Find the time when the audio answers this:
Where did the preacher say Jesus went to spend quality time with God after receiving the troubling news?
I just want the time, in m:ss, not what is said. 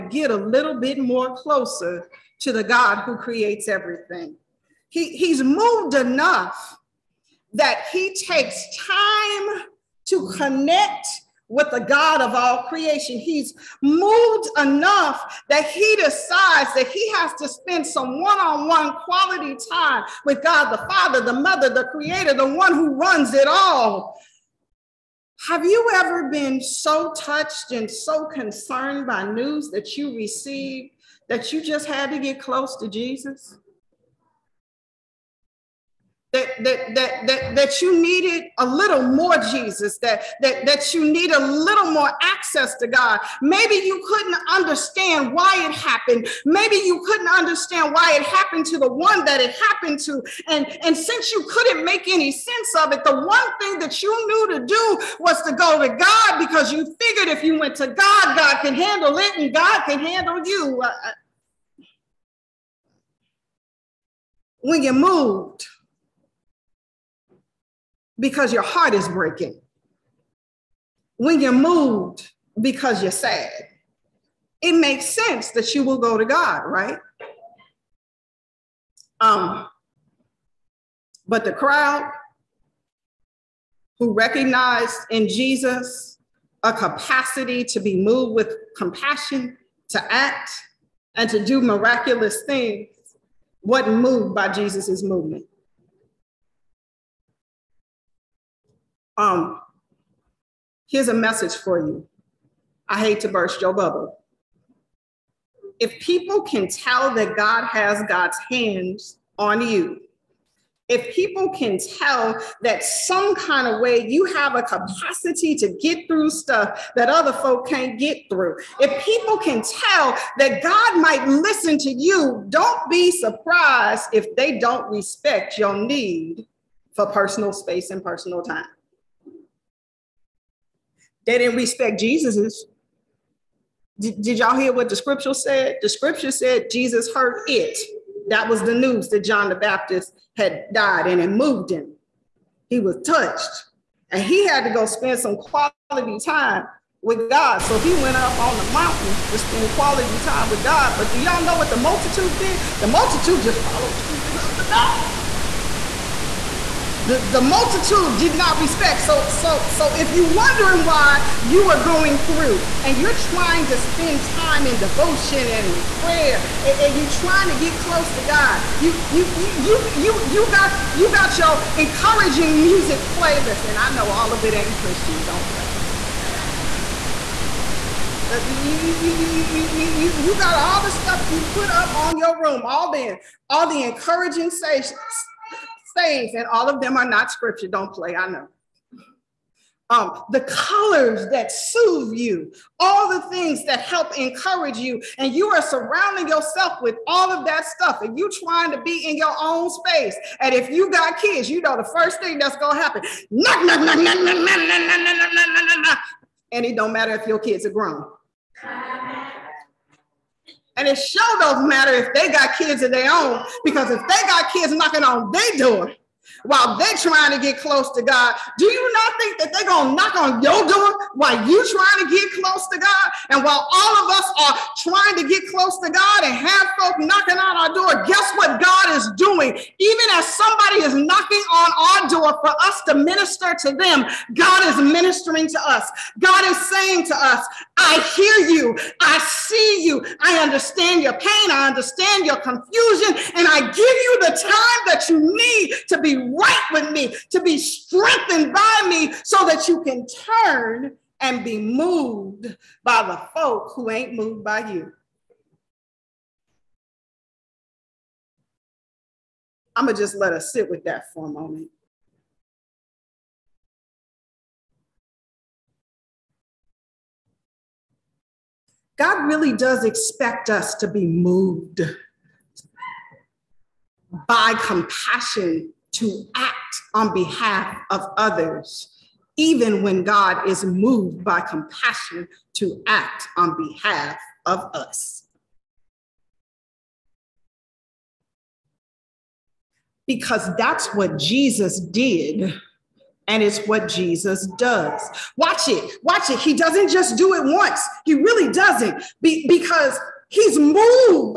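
2:28.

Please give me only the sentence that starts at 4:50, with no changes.
Because that's what Jesus did and it's what Jesus does.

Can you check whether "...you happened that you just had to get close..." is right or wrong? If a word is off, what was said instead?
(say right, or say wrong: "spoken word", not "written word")
wrong: "received", not "happened".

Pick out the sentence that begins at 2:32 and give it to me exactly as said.
The multitude just followed Jesus up the mountain.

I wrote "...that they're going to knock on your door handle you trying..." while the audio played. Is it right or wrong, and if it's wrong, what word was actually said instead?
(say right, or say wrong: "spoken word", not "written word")
wrong: "while", not "handle".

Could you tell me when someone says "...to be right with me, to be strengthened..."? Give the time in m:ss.
4:05.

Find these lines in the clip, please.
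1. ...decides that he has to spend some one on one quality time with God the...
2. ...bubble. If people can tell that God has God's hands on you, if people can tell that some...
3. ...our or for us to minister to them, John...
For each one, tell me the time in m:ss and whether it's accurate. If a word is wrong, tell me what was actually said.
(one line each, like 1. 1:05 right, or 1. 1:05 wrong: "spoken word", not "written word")
1. 0:15 right
2. 1:43 right
3. 3:51 wrong: "God", not "John".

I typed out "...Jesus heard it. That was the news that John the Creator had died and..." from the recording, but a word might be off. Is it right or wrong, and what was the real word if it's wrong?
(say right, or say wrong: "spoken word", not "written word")
wrong: "Baptist", not "Creator".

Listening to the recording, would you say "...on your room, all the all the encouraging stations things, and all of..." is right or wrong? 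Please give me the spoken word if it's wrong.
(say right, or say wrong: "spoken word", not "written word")
right.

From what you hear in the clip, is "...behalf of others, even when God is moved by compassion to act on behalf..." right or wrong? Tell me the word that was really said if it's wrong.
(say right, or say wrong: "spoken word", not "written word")
right.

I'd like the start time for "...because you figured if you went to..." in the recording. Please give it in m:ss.
0:56.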